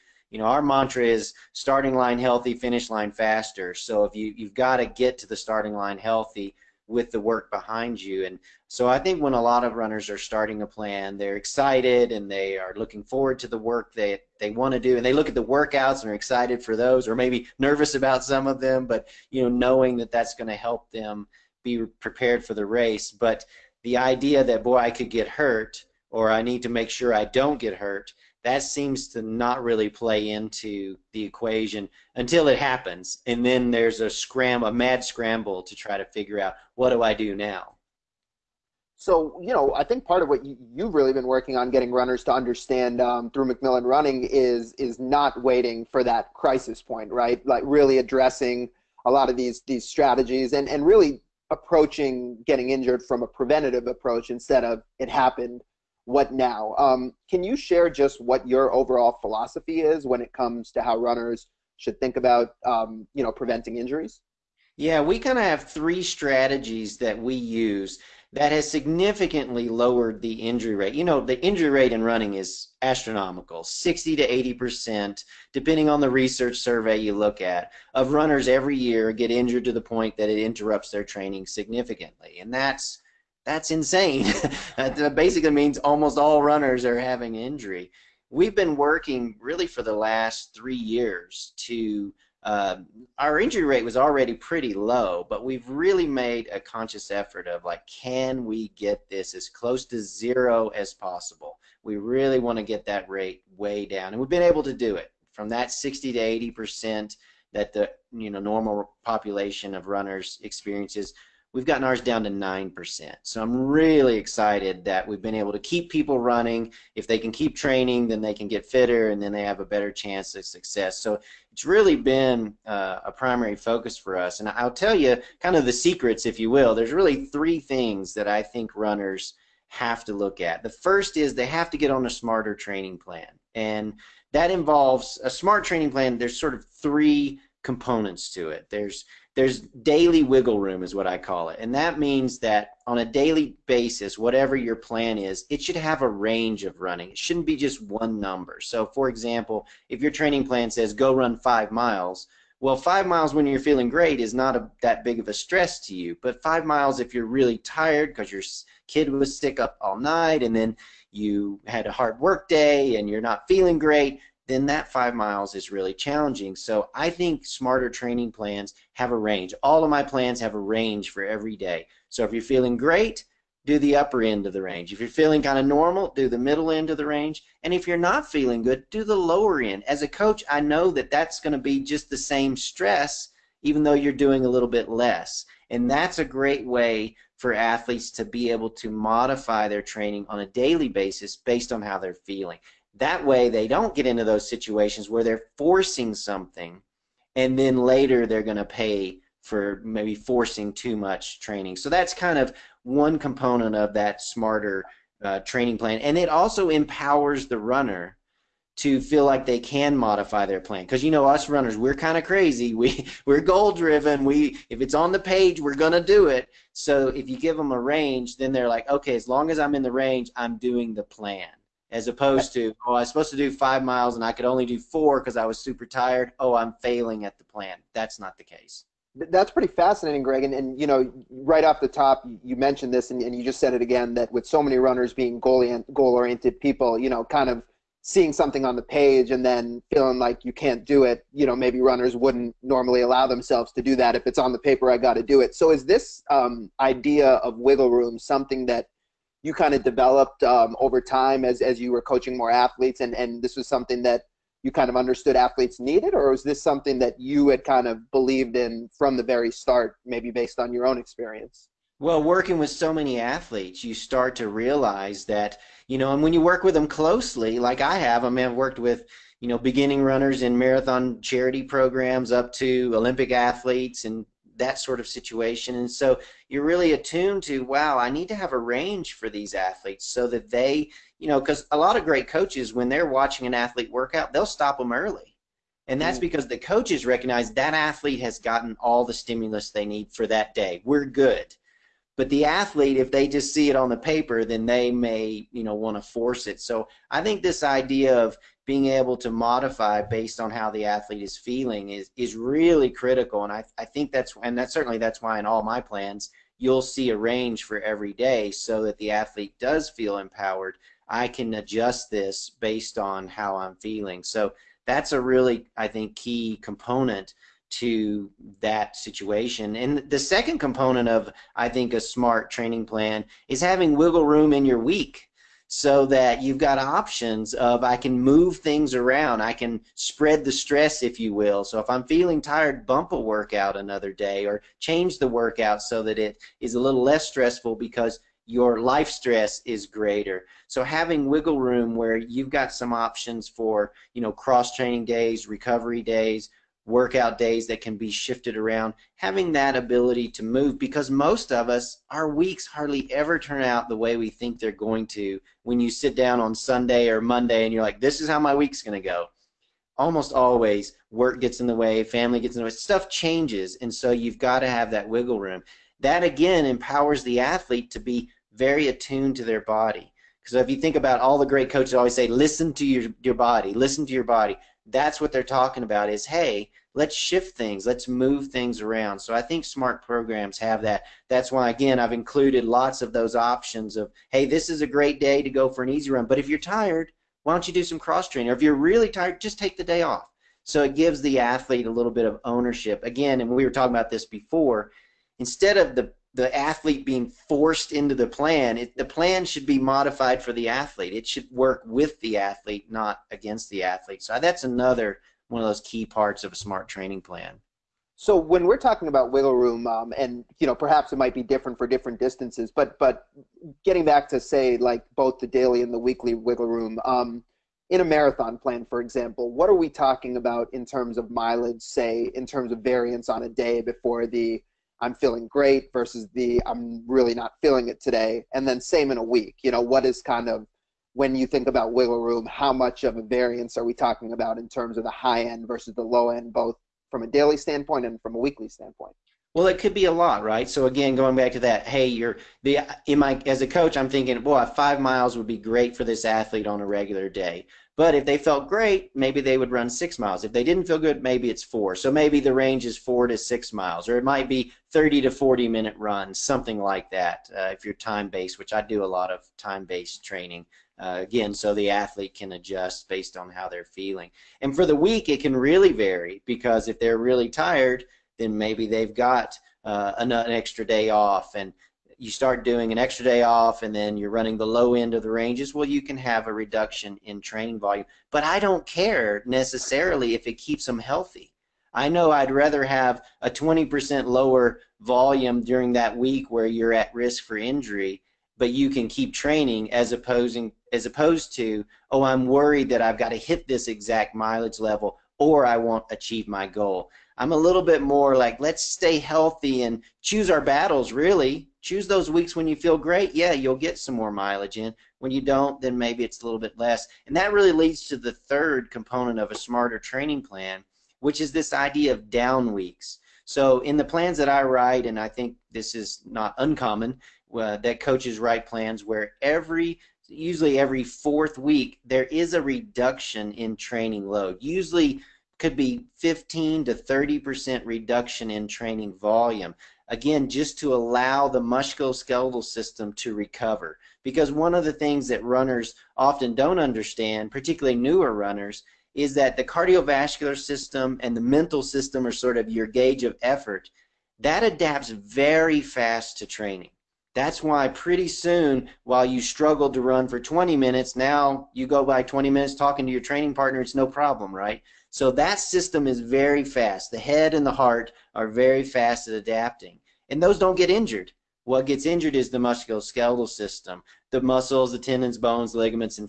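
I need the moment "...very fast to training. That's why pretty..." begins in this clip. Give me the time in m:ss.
9:05.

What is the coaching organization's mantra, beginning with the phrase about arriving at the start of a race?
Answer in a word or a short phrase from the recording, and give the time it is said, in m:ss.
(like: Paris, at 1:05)
starting line healthy, finish line faster, at 0:01.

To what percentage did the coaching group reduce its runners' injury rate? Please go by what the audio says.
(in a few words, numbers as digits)
9%.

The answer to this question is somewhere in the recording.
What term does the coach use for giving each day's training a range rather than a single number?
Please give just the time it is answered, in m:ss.
2:19.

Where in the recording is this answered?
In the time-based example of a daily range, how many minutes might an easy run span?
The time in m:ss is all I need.
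7:34.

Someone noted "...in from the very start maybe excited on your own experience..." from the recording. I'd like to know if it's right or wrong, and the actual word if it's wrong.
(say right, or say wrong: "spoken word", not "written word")
wrong: "based", not "excited".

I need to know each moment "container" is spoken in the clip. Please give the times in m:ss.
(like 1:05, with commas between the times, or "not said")
not said.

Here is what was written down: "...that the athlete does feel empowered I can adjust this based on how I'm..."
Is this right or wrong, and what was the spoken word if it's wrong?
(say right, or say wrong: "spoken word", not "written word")
right.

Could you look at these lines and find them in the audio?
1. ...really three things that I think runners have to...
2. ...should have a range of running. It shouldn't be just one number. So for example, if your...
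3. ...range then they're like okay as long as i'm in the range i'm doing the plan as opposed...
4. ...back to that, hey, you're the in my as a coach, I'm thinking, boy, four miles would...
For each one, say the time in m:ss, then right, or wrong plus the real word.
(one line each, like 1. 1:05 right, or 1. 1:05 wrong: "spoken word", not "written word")
1. 2:06 right
2. 2:25 right
3. 3:37 right
4. 7:21 wrong: "five", not "four".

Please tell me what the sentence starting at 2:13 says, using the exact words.
And that involves a smart training plan.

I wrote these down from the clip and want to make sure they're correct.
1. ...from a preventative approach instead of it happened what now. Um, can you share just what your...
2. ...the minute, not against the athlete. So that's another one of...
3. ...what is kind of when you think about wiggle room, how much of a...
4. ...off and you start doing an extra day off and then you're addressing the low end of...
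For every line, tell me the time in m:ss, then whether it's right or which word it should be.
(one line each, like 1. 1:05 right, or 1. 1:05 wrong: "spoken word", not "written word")
1. 0:53 right
2. 6:42 wrong: "athlete", not "minute"
3. 7:09 right
4. 7:51 wrong: "running", not "addressing".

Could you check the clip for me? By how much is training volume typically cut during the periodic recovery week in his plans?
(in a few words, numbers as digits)
15 to 30 percent.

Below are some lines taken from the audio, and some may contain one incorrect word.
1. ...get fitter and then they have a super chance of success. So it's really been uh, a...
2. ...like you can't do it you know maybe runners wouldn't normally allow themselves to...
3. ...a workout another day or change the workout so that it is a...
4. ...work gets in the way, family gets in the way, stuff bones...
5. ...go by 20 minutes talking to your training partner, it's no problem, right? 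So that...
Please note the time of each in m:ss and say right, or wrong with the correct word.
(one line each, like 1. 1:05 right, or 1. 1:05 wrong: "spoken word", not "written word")
1. 1:58 wrong: "better", not "super"
2. 4:00 right
3. 5:33 right
4. 6:01 wrong: "changes", not "bones"
5. 9:11 right.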